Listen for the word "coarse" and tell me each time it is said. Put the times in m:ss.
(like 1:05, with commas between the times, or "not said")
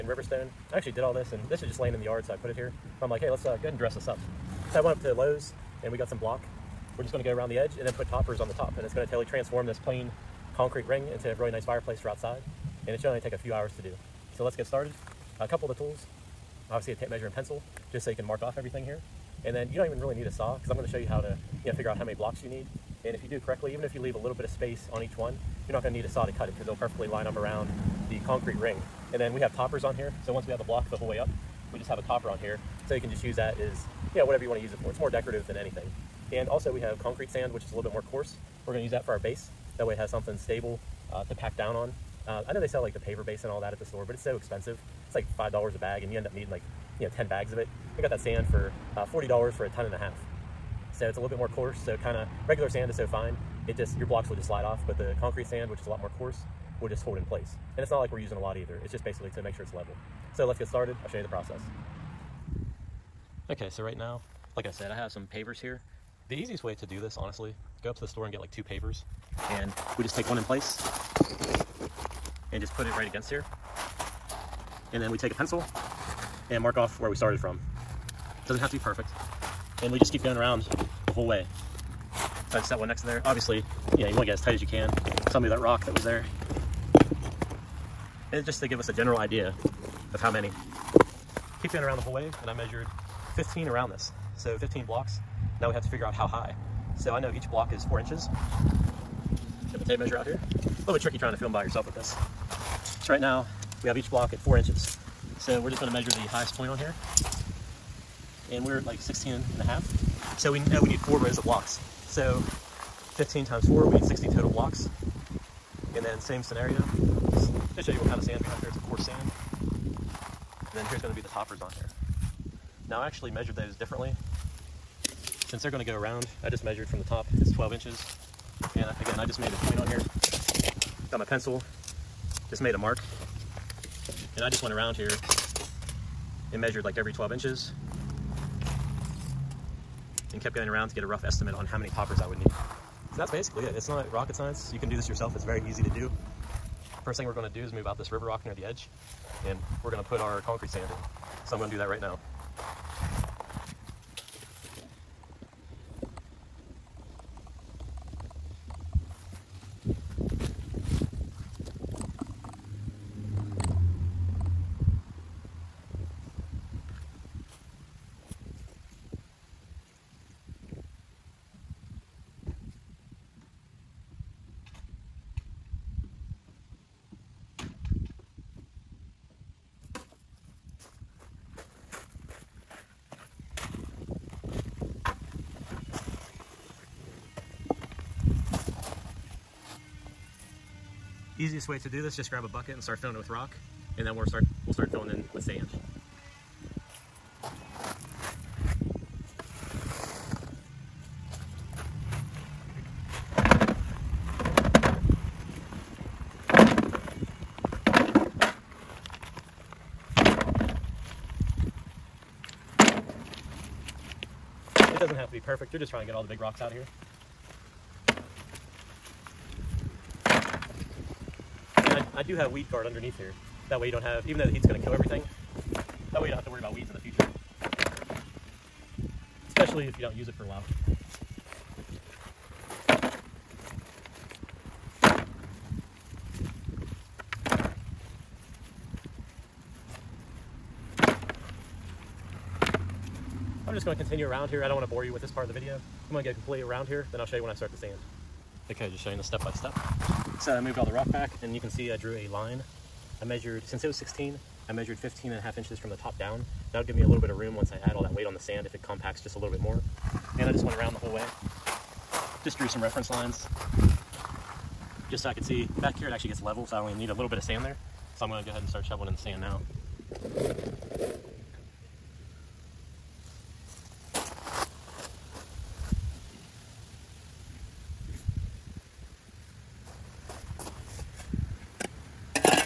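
0:38, 0:51, 0:56, 1:58.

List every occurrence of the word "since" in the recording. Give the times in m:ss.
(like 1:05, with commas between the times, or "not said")
2:05, 4:13.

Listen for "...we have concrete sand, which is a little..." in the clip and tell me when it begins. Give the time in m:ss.
0:36.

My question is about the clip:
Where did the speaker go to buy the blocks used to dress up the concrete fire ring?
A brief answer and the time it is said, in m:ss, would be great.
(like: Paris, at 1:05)
Lowe's, at 0:05.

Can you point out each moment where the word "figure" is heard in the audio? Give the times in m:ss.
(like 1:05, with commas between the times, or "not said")
0:21, 1:35.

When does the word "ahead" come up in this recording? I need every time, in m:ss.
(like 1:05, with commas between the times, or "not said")
0:03, 4:28.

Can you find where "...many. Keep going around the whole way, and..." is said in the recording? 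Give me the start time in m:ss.
1:30.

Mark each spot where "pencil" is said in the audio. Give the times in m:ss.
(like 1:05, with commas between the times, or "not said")
0:17, 1:15, 2:11.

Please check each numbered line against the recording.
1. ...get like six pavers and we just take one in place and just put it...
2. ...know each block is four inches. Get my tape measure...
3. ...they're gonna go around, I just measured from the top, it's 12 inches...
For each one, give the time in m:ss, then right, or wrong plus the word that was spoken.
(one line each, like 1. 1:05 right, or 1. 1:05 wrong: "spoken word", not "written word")
1. 1:08 wrong: "two", not "six"
2. 1:37 right
3. 2:05 right.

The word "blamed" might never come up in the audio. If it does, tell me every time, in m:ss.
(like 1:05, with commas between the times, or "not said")
not said.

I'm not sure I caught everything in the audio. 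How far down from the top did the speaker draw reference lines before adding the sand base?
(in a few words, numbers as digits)
15 and a half inches.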